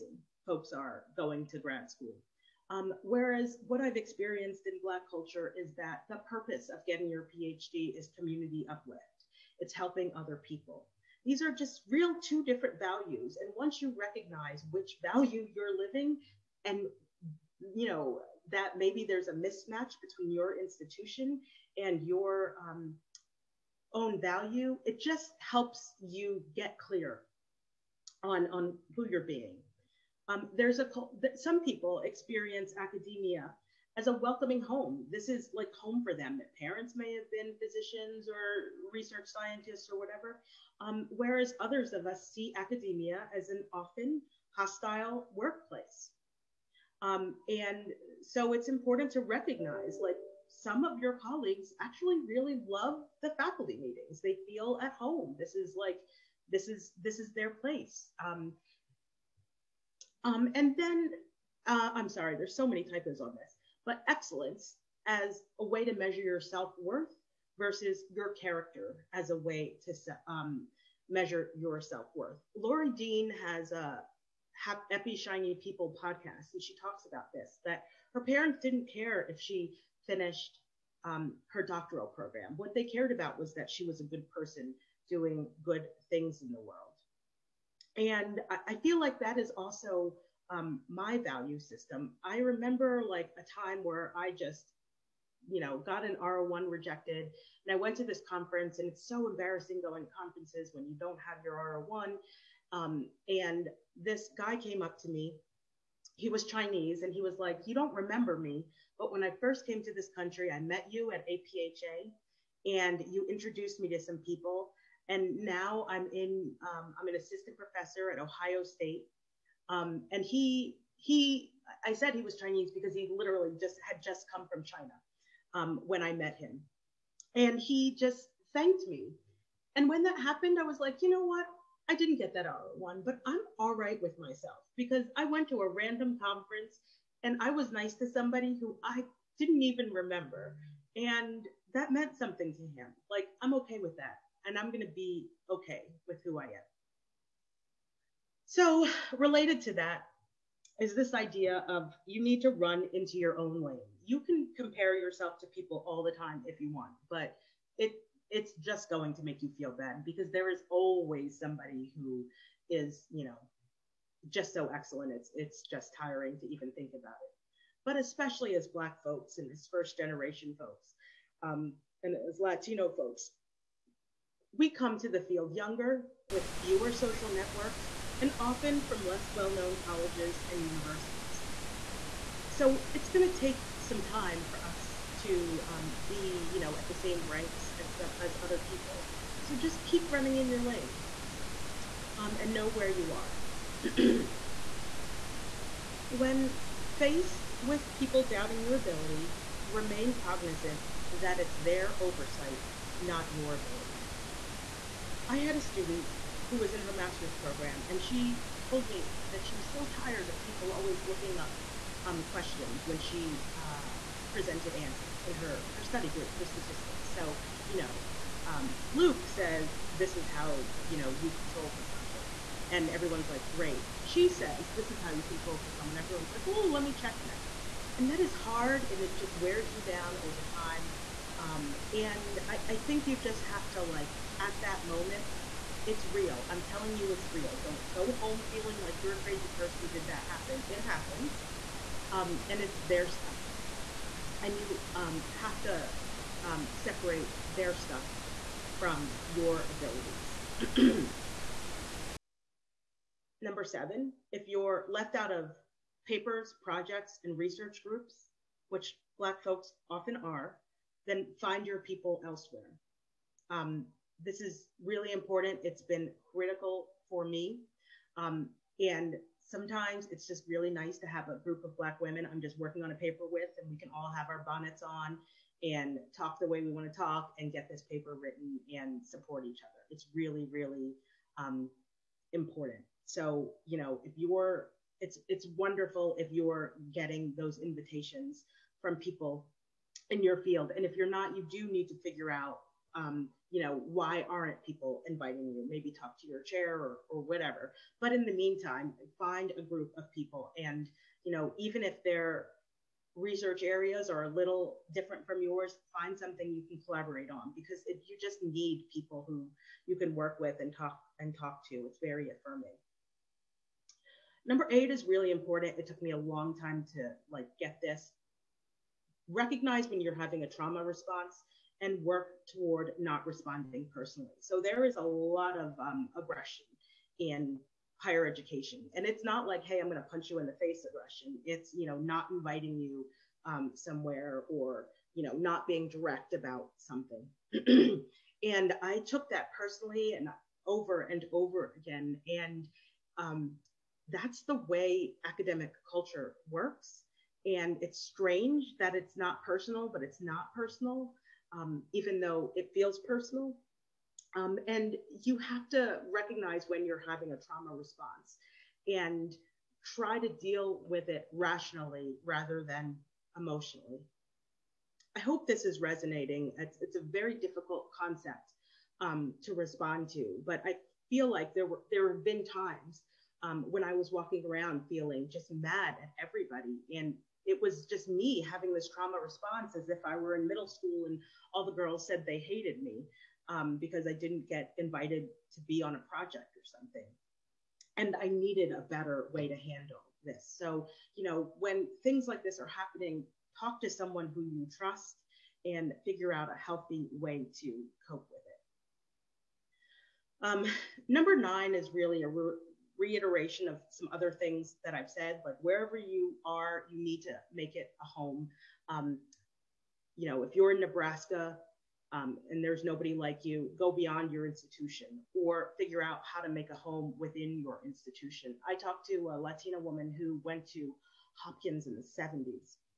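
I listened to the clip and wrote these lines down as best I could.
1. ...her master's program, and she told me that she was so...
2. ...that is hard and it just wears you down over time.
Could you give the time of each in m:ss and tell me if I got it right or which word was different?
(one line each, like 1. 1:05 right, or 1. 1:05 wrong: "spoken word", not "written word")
1. 3:26 right
2. 3:48 right.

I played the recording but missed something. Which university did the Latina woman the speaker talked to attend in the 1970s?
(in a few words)
Hopkins.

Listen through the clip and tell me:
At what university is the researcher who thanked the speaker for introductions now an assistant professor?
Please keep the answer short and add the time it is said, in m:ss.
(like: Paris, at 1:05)
Ohio State, at 1:58.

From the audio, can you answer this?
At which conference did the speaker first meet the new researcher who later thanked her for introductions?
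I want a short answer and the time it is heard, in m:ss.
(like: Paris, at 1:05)
APHA, at 1:51.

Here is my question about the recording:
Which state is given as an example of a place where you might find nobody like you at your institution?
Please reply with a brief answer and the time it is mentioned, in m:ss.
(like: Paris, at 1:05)
Nebraska, at 6:50.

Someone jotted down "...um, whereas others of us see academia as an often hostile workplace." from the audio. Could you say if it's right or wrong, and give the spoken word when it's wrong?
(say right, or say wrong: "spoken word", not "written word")
right.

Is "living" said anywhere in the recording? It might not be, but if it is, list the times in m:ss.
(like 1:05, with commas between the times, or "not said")
0:15.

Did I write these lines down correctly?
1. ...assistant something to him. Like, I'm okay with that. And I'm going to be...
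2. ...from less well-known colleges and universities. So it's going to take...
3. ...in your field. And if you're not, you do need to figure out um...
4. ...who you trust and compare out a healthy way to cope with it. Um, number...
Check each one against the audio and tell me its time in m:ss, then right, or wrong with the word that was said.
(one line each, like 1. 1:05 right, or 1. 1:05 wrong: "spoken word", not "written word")
1. 2:21 wrong: "meant", not "assistant"
2. 2:58 right
3. 4:50 right
4. 6:34 wrong: "figure", not "compare".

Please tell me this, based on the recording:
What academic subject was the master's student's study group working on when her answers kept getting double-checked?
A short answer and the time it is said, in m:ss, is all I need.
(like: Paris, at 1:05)
Statistics, at 3:36.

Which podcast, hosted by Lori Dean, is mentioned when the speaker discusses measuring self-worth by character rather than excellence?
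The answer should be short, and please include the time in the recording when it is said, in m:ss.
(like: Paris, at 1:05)
Happy Shiny People, at 1:14.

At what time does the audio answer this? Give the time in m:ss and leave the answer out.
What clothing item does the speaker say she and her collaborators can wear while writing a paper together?
4:34.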